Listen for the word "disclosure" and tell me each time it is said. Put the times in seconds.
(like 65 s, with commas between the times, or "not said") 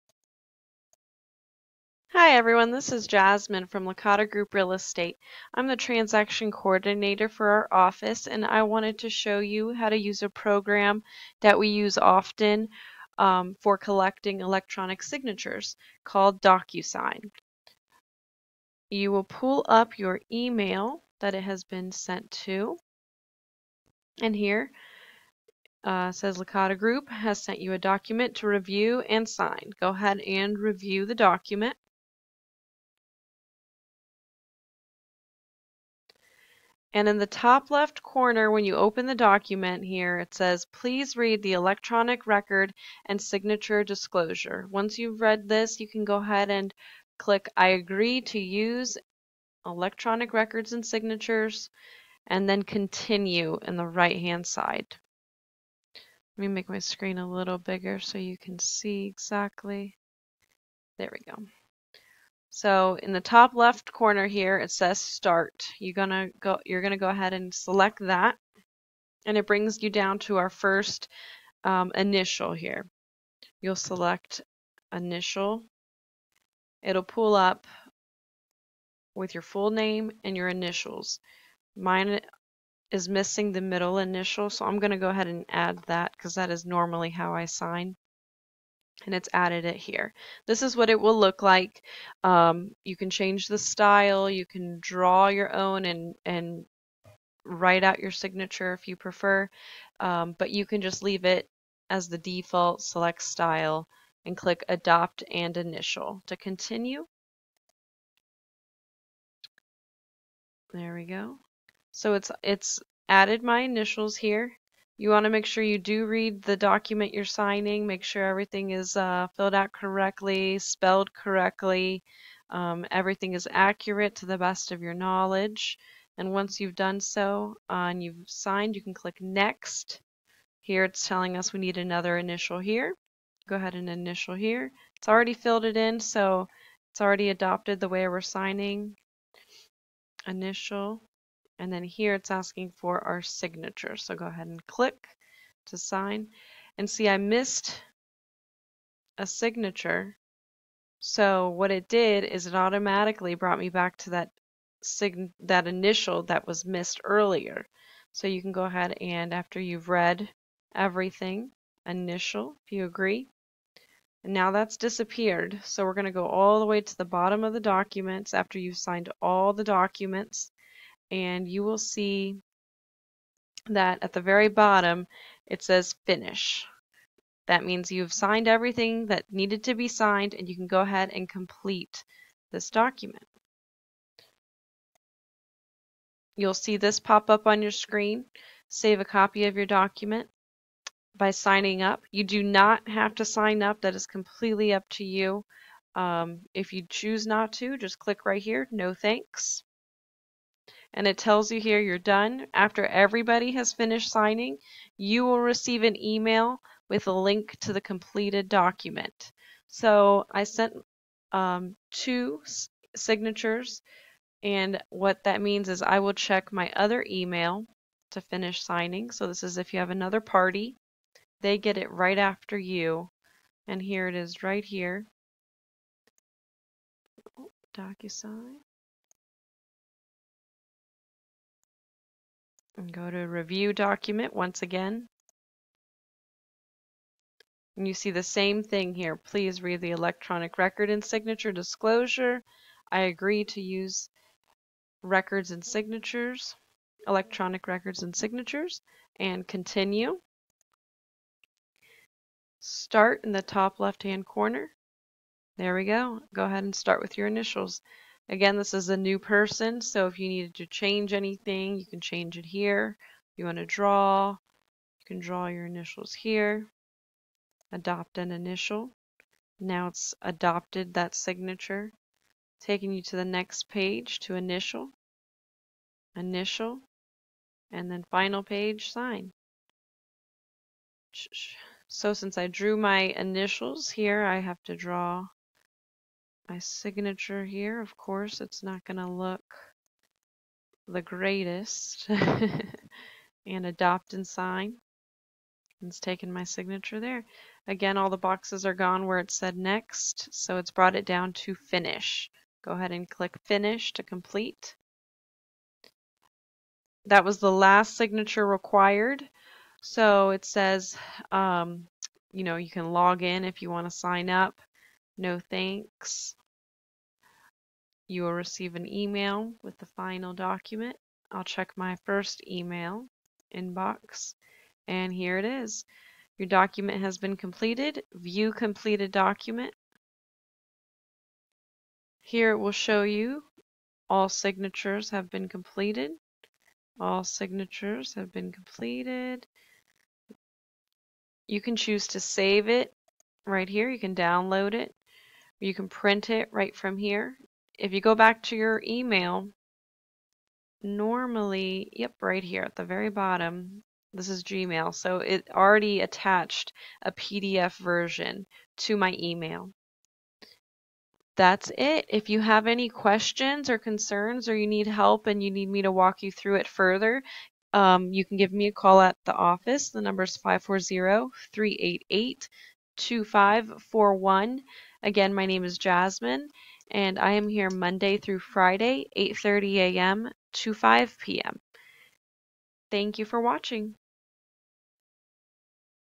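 43 s, 241 s.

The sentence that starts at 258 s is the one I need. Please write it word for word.
Again, this is a new person, so if you needed to change anything, you can change it here.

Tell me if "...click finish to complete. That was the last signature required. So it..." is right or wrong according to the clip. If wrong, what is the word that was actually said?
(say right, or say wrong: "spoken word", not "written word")
right.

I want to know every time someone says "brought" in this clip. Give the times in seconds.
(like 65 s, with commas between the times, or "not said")
153 s, 300 s.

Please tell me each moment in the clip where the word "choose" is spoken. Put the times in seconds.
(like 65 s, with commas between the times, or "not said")
196 s, 341 s.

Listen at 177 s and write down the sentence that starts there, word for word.
That means you've signed everything that needed to be signed and you can go ahead and complete this document.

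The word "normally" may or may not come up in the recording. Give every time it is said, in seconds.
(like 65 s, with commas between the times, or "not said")
86 s, 350 s.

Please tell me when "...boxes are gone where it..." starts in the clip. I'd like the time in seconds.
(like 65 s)
298 s.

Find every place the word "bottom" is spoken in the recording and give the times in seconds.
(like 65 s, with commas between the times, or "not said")
167 s, 174 s, 353 s.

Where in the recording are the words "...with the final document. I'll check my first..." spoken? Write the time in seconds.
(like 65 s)
319 s.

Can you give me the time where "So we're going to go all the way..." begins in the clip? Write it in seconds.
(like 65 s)
165 s.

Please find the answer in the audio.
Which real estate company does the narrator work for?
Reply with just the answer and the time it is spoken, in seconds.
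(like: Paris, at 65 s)
Licata Group Real Estate, at 3 s.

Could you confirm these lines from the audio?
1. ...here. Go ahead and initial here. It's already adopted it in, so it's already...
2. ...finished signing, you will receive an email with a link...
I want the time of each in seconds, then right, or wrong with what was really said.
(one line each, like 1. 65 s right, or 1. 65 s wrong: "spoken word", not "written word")
1. 132 s wrong: "filled", not "adopted"
2. 203 s right.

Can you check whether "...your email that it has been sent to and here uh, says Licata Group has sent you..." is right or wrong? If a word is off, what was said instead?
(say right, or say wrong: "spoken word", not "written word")
right.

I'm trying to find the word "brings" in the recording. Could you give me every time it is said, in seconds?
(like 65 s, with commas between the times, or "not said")
69 s.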